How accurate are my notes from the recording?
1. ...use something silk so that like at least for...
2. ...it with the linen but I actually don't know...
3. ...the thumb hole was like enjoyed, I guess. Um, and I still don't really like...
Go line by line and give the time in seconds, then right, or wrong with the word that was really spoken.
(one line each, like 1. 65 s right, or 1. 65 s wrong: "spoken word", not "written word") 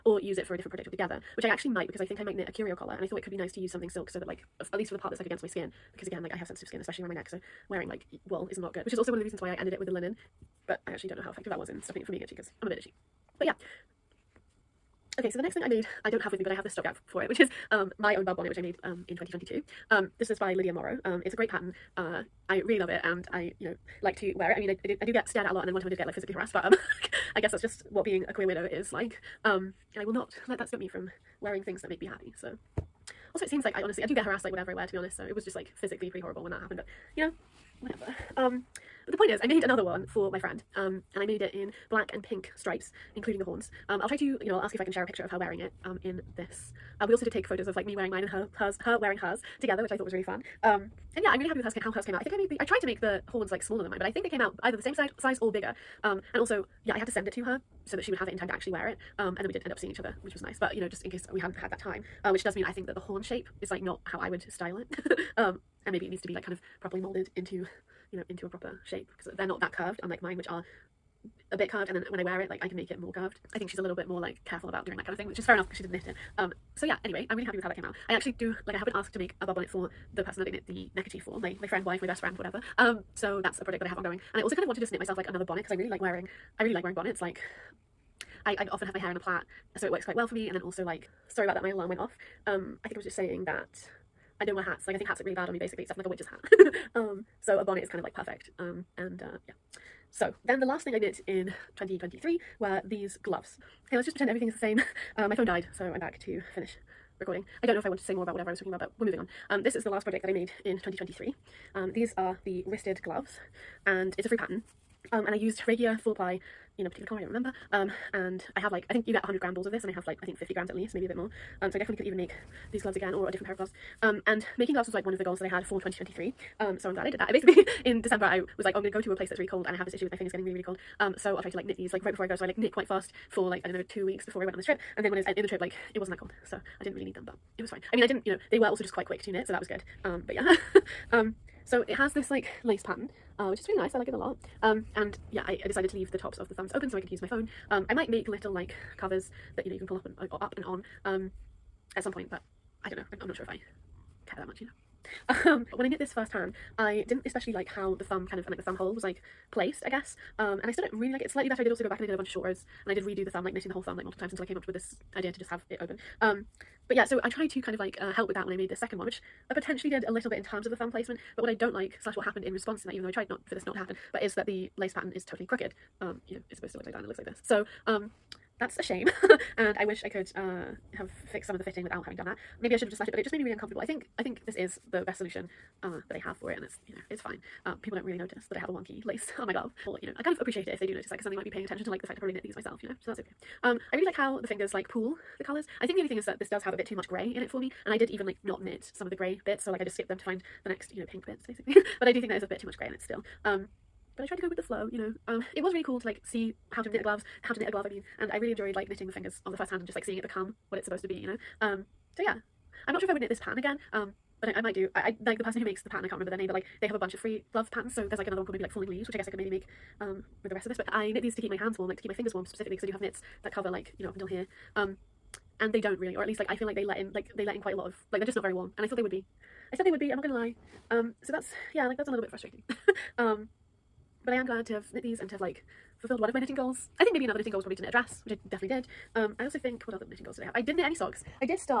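1. 3 s right
2. 9 s right
3. 158 s wrong: "placed", not "enjoyed".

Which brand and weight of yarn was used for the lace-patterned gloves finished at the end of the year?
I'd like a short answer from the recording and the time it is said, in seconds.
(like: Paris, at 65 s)
Regia four ply, at 115 s.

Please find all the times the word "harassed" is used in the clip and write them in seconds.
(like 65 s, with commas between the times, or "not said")
26 s, 34 s.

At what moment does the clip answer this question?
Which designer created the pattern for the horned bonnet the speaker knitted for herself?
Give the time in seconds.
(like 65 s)
20 s.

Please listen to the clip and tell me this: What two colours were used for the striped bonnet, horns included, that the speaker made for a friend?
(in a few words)
black and pink.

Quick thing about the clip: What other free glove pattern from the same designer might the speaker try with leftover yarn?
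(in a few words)
Falling Leaves.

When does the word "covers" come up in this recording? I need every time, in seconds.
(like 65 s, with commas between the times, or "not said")
148 s, 223 s.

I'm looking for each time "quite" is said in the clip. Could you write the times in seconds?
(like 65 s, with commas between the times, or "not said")
90 s, 132 s, 138 s, 227 s.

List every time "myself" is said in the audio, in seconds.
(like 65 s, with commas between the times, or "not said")
84 s, 192 s.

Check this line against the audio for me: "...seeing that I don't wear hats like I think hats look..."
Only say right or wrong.
wrong.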